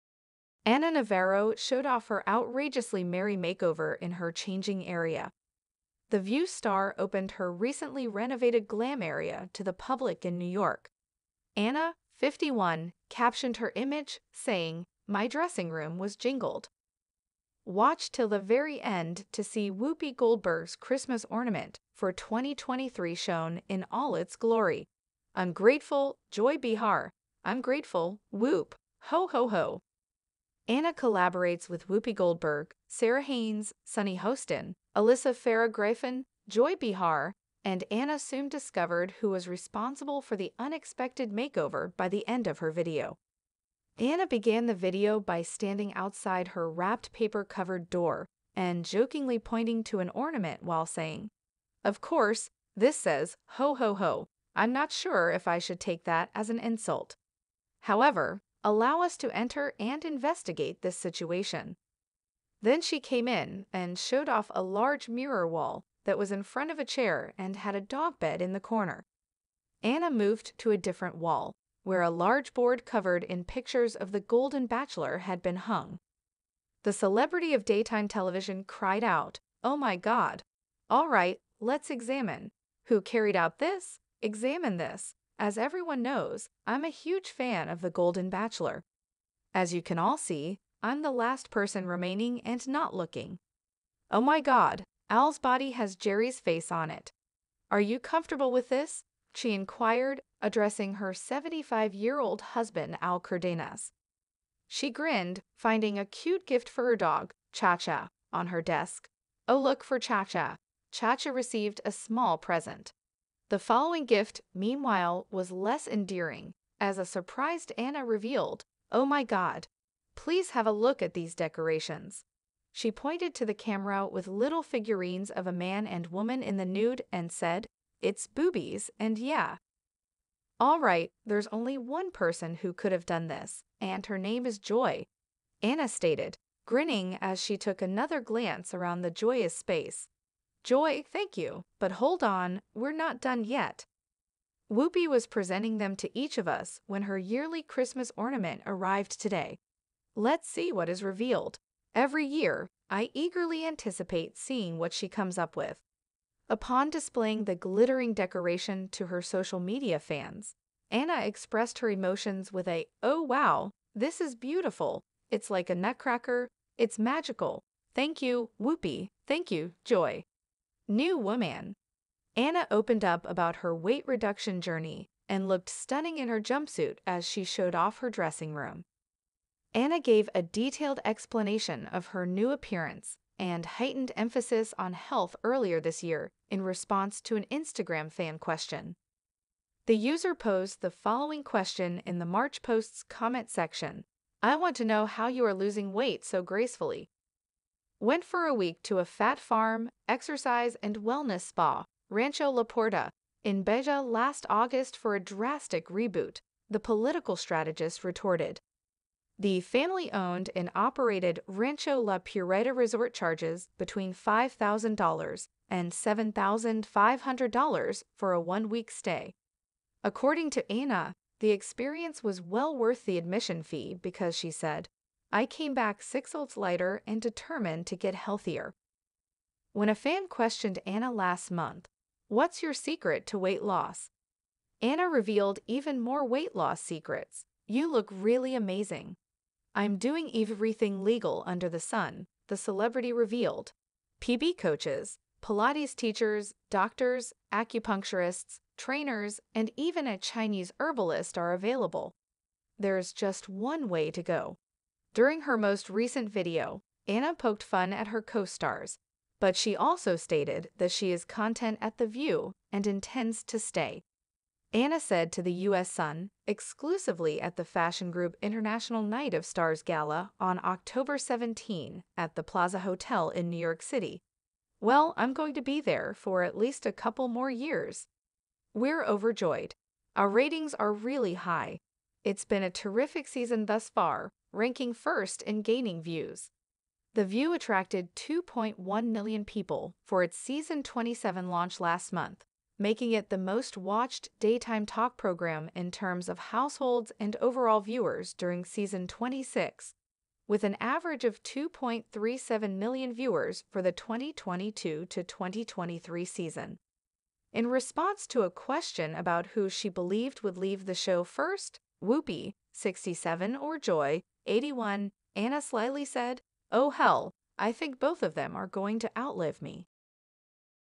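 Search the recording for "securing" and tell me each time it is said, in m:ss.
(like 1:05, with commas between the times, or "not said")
not said.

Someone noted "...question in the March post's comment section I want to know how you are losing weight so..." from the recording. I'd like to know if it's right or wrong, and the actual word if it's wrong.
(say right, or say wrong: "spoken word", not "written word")
right.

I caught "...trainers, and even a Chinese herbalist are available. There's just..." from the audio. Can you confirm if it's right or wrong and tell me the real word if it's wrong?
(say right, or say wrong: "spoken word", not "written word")
right.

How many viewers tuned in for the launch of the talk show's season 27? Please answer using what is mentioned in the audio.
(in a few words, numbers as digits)
2.1 million.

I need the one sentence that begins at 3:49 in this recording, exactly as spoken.
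When a fan questioned Ana last month, What's your secret to weight loss?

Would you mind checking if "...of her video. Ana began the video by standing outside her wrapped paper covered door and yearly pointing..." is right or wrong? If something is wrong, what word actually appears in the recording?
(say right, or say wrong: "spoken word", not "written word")
wrong: "jokingly", not "yearly".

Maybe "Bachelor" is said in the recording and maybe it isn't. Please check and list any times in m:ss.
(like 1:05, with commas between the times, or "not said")
1:14, 1:28.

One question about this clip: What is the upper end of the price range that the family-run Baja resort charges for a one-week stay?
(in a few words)
$7,500.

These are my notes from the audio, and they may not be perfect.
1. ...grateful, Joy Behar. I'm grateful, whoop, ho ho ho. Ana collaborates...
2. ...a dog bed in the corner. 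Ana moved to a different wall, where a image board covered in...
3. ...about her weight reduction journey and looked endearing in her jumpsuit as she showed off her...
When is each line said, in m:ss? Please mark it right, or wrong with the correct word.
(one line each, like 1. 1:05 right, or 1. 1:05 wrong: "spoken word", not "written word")
1. 0:25 right
2. 1:07 wrong: "large", not "image"
3. 2:53 wrong: "stunning", not "endearing".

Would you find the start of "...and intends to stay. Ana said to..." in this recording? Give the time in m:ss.
4:22.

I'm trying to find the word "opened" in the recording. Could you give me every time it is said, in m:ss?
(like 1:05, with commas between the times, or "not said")
0:06, 2:52.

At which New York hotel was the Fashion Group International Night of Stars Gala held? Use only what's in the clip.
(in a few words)
Plaza Hotel.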